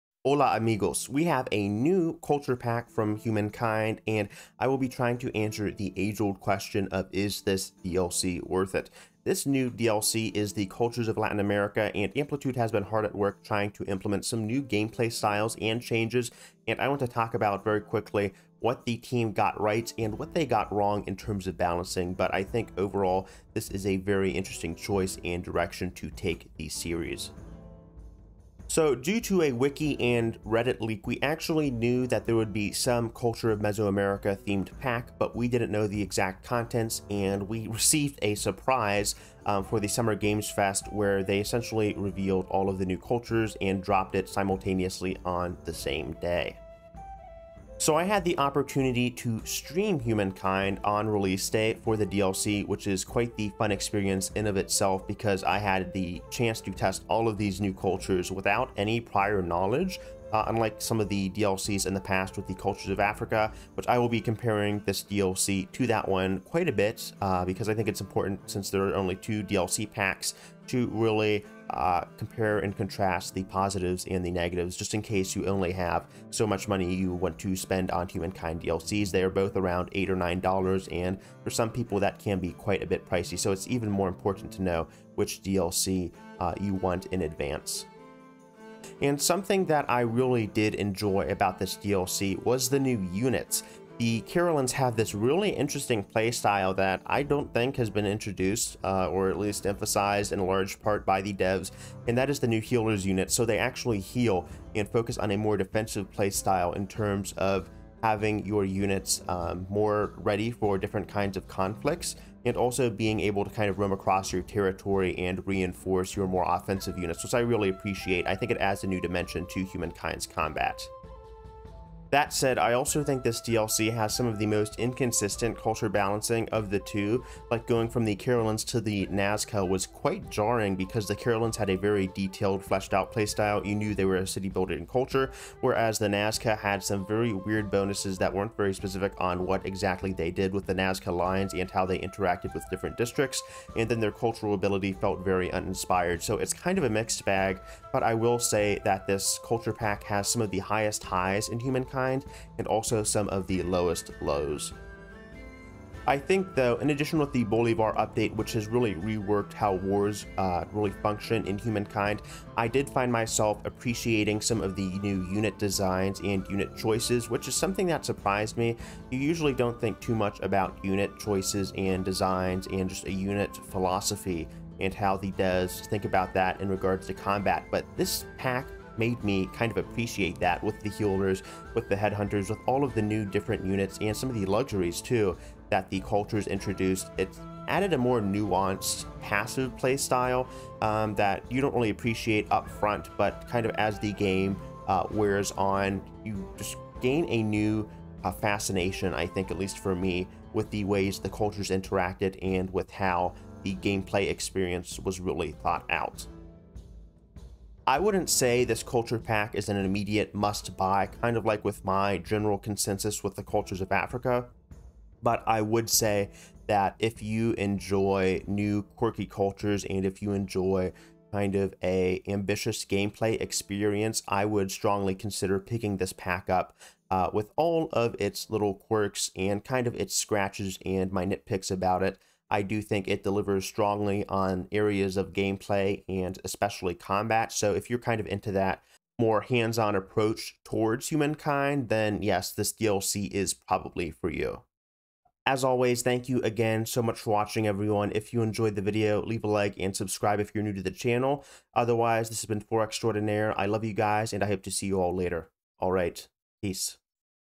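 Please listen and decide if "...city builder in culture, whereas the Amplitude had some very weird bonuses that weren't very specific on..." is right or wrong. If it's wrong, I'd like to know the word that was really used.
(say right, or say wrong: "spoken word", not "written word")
wrong: "Nazca", not "Amplitude".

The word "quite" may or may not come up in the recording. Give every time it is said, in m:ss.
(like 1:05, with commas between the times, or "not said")
0:53, 1:06, 1:22, 2:09.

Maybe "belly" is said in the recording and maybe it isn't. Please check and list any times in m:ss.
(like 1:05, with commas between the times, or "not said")
not said.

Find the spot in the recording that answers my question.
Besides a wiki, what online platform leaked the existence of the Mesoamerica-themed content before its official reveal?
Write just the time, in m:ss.
0:30.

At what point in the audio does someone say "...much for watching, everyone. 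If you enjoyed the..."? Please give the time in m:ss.
4:07.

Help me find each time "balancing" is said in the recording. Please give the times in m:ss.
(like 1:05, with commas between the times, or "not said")
0:21, 2:05.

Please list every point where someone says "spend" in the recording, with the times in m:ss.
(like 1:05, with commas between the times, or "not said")
1:17.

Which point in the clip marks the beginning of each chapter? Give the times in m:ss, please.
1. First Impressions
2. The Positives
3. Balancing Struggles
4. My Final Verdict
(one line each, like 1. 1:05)
1. 0:47
2. 1:29
3. 2:01
4. 3:27.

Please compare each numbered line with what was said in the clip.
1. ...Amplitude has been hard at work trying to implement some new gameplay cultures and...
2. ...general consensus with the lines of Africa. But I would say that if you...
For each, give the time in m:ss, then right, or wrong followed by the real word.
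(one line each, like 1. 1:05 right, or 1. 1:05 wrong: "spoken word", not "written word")
1. 0:12 wrong: "styles", not "cultures"
2. 3:32 wrong: "cultures", not "lines".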